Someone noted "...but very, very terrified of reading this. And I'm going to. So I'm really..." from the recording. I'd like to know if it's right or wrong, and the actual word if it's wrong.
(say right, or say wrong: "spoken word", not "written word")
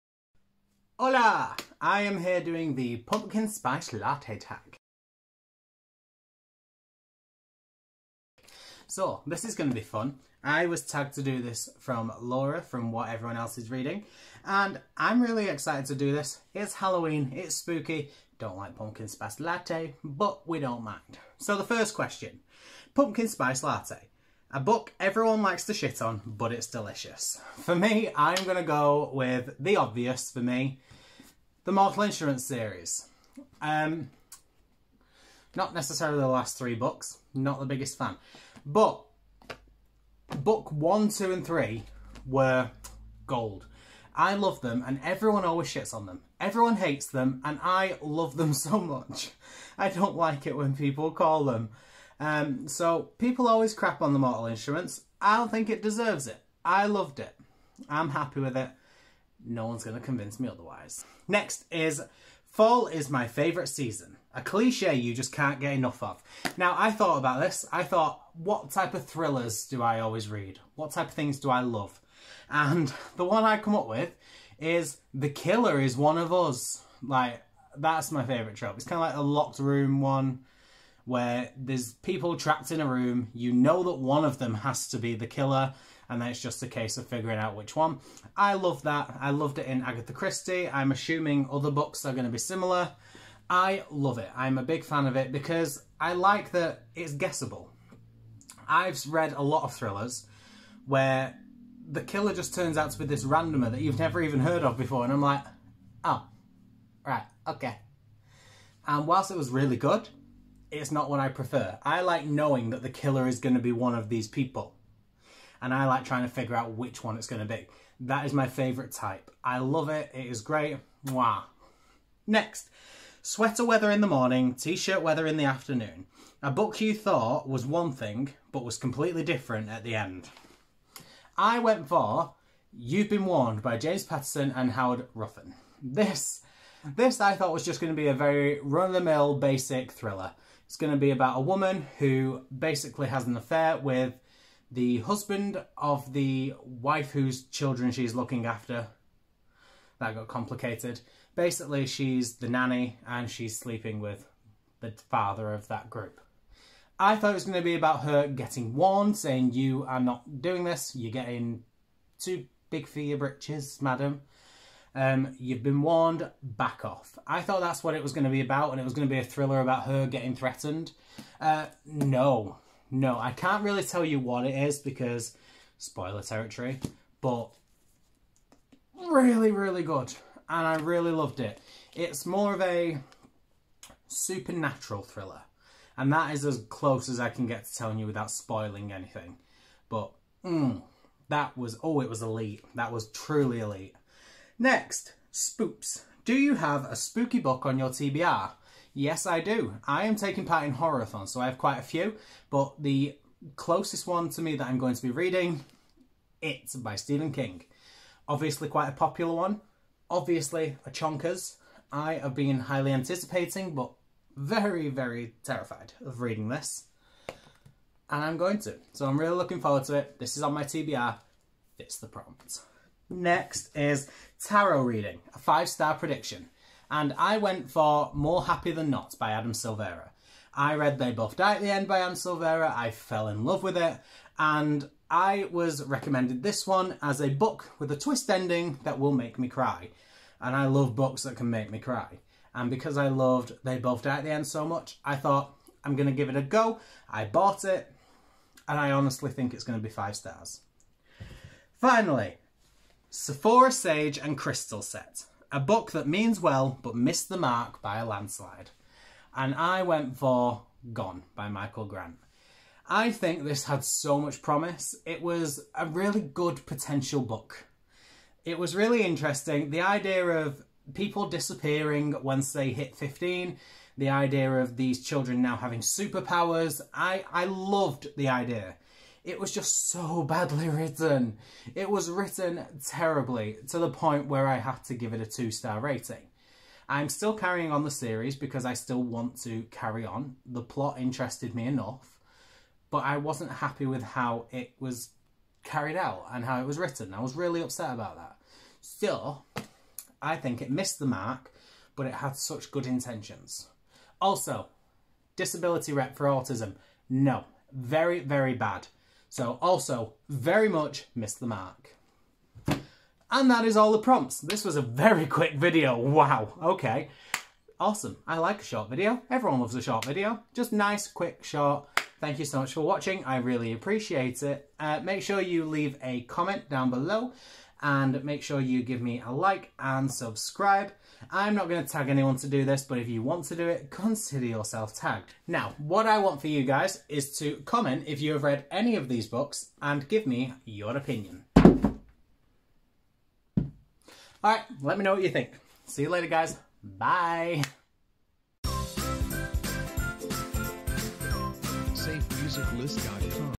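right.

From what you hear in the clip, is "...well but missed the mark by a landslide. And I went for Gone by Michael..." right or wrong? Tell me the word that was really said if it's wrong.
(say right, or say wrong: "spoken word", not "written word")
right.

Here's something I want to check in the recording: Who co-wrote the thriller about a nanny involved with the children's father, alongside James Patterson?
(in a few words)
Howard Roughan.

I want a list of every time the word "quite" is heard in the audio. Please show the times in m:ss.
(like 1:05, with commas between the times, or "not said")
3:21, 3:28.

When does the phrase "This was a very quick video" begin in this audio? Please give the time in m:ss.
5:14.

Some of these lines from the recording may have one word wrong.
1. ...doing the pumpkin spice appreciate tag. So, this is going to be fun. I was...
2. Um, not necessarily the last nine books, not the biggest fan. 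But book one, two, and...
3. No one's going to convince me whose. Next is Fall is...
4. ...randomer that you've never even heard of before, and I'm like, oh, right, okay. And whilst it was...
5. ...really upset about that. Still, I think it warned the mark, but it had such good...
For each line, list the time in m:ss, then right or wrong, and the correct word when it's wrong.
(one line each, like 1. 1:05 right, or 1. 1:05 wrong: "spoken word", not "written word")
1. 0:02 wrong: "latte", not "appreciate"
2. 0:33 wrong: "three", not "nine"
3. 0:59 wrong: "otherwise", not "whose"
4. 1:43 right
5. 4:57 wrong: "missed", not "warned".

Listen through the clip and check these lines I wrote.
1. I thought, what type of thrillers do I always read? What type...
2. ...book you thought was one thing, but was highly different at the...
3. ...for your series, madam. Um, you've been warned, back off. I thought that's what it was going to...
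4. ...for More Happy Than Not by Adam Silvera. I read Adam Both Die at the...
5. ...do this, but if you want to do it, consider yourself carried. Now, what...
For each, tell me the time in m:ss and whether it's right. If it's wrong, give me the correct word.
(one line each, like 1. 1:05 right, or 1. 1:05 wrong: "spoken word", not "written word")
1. 1:07 right
2. 2:06 wrong: "completely", not "highly"
3. 2:42 wrong: "britches", not "series"
4. 3:47 wrong: "They", not "Adam"
5. 5:32 wrong: "tagged", not "carried".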